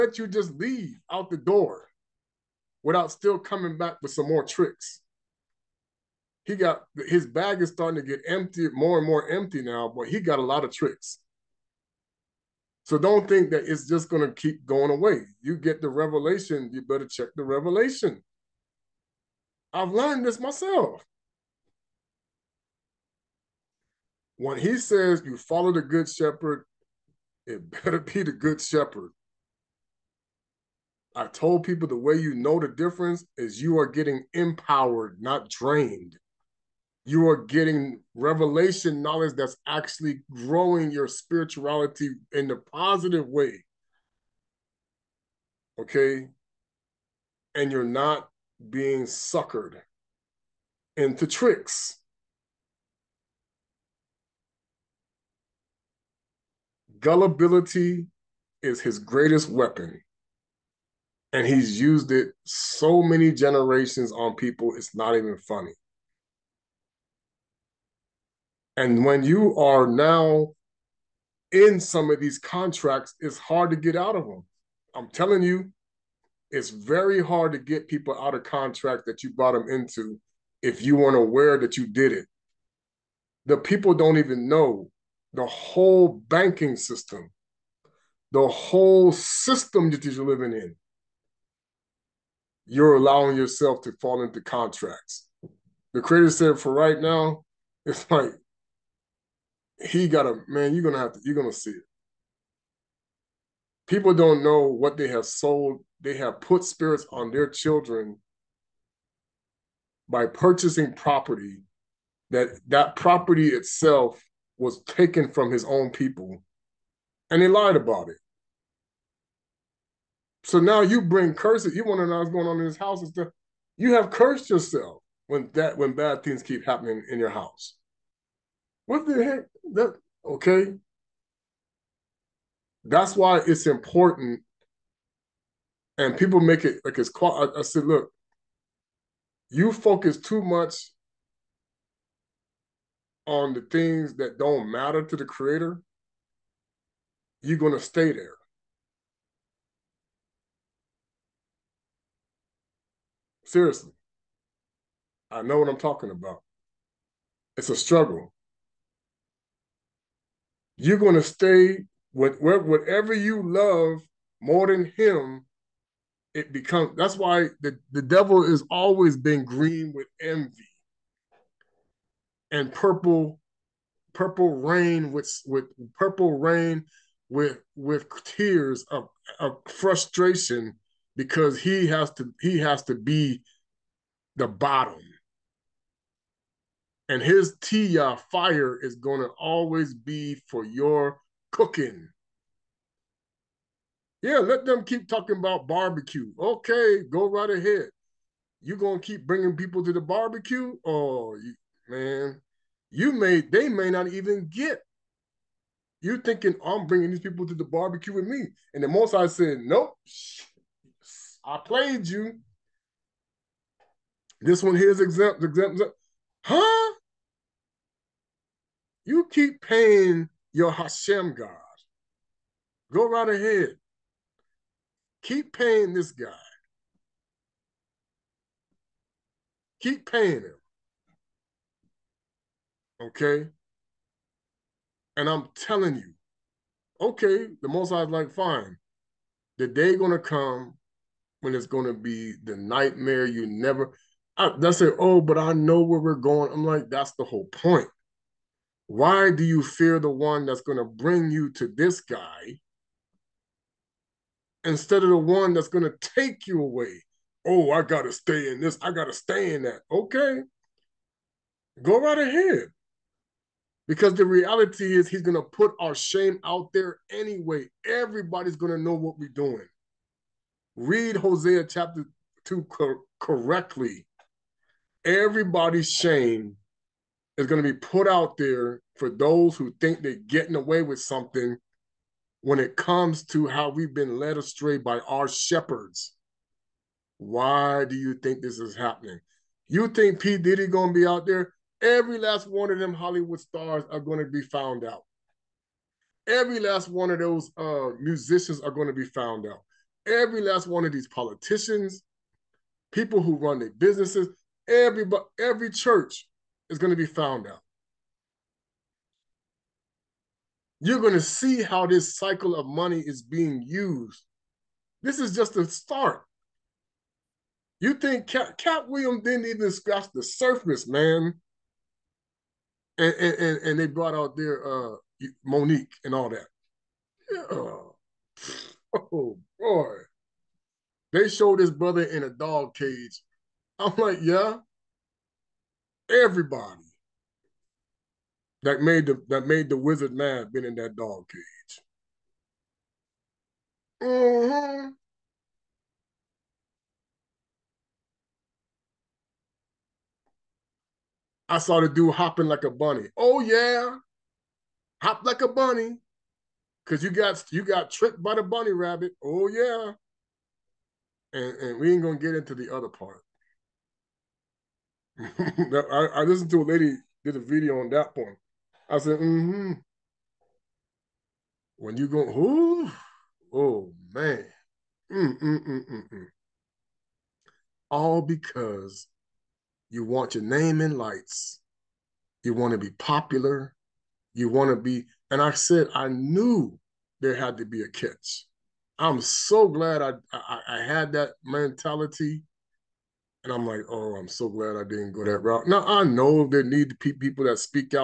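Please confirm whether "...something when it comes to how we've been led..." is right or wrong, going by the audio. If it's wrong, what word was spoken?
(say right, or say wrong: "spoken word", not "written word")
right.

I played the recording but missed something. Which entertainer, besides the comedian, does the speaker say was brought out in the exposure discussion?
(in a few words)
Mo'Nique.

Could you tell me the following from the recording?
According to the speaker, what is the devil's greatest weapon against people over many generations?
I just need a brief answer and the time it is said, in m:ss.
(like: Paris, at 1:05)
Gullibility, at 0:56.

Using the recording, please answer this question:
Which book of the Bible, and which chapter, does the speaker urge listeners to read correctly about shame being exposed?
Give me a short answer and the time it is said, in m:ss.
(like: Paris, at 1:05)
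Hosea chapter 2, at 4:31.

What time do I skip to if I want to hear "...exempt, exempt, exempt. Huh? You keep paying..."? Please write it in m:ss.
3:34.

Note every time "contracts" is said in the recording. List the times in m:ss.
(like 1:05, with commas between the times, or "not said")
1:12, 1:18, 1:34.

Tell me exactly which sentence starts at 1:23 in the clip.
The people don't even know the whole banking system, the whole system that you're living in.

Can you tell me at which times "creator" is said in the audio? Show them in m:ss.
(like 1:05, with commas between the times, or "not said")
1:36, 2:25.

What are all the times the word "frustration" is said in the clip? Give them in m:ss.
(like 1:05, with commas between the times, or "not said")
2:59.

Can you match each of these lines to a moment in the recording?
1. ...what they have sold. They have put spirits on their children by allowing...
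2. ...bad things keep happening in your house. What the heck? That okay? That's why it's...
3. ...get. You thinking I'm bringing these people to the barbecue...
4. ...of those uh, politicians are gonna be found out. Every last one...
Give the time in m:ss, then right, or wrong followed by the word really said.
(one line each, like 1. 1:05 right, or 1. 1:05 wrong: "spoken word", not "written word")
1. 1:44 wrong: "purchasing", not "allowing"
2. 2:05 right
3. 3:24 right
4. 4:57 wrong: "musicians", not "politicians".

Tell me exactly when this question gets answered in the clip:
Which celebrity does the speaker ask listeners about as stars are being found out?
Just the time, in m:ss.
4:50.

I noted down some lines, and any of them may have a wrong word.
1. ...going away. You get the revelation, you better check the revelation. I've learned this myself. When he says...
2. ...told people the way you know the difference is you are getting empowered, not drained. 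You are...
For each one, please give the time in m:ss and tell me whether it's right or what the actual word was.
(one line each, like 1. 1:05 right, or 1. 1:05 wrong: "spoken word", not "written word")
1. 0:14 right
2. 0:31 right.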